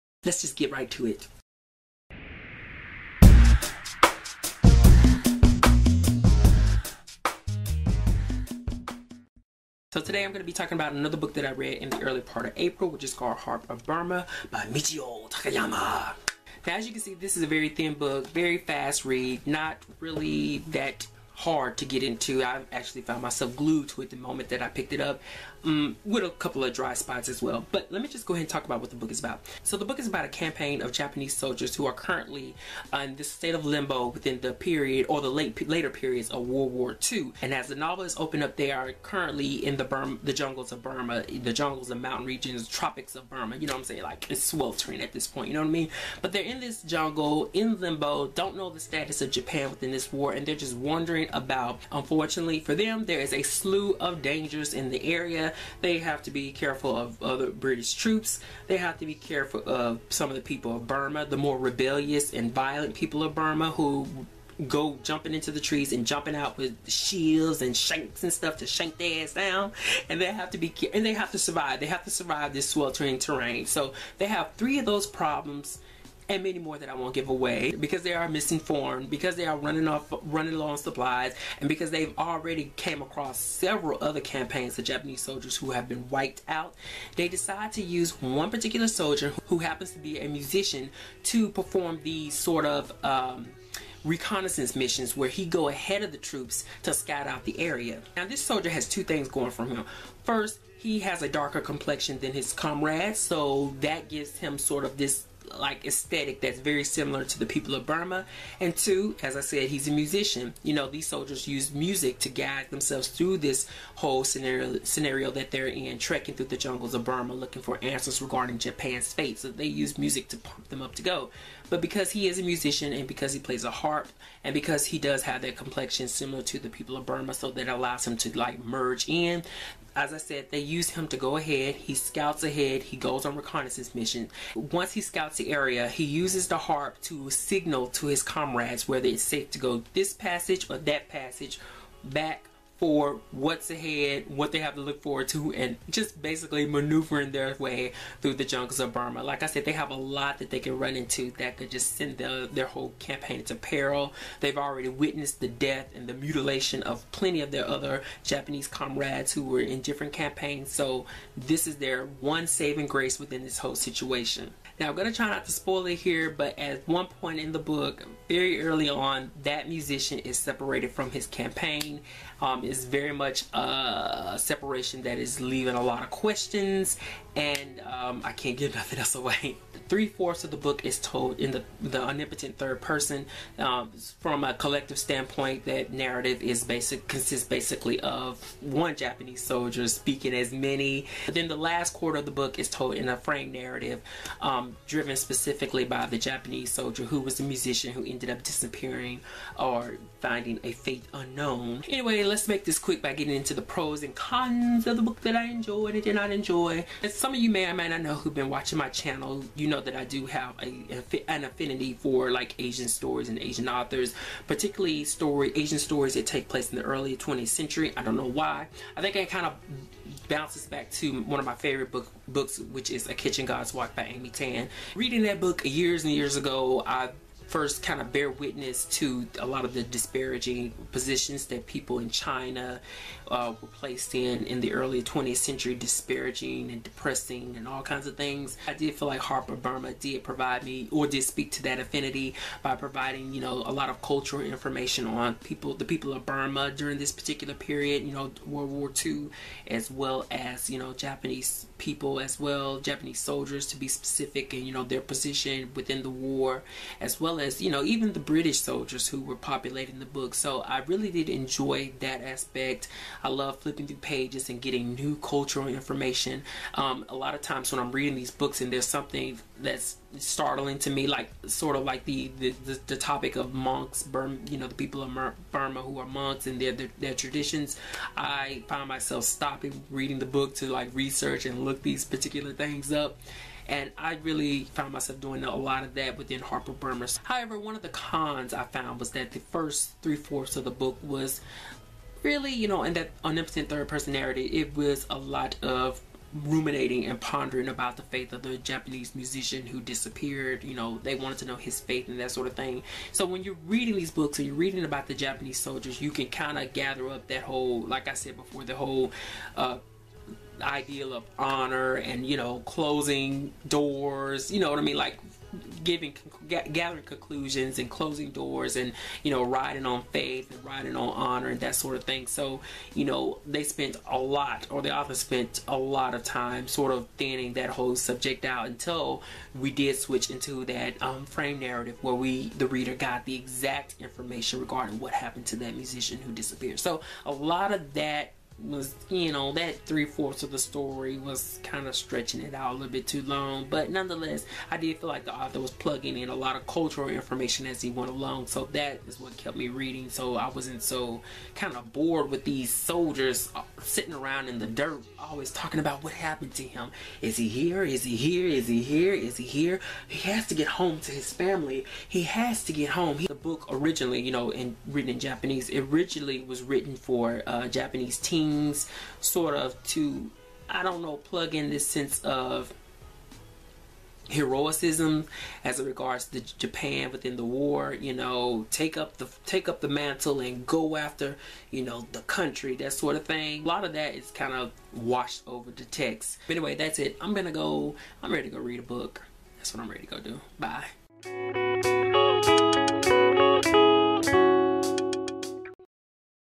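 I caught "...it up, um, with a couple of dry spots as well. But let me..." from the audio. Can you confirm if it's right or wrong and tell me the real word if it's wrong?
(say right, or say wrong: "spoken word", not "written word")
right.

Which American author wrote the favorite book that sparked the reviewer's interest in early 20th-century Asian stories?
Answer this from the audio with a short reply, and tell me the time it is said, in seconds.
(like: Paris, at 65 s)
Amy Tan, at 224 s.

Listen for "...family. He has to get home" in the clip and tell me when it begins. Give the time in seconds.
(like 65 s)
361 s.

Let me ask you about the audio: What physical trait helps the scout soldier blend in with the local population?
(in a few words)
darker complexion.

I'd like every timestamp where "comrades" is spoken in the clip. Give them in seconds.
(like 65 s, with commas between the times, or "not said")
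102 s, 138 s, 158 s.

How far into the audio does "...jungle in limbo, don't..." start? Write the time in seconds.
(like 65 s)
46 s.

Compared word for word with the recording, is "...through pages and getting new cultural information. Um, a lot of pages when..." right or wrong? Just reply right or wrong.
wrong.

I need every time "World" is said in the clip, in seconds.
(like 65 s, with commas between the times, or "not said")
36 s, 248 s.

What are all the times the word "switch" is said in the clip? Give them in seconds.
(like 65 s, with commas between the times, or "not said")
329 s.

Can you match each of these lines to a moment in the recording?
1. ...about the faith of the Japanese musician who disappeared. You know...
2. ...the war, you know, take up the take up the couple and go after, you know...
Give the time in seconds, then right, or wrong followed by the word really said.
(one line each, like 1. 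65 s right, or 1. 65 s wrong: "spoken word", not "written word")
1. 297 s right
2. 377 s wrong: "mantle", not "couple".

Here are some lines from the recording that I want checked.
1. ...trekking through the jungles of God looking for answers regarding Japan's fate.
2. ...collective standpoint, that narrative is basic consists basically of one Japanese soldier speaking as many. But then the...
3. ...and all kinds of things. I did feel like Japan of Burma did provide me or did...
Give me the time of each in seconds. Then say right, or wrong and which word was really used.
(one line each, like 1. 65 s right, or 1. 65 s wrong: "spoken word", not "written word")
1. 115 s wrong: "Burma", not "God"
2. 184 s right
3. 237 s wrong: "Harp", not "Japan".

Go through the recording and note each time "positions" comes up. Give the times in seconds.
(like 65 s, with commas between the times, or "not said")
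230 s, 255 s.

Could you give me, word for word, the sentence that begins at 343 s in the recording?
But nonetheless, I did feel like the author was plugging in a lot of cultural information as he went along.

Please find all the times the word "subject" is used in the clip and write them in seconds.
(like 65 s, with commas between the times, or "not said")
327 s.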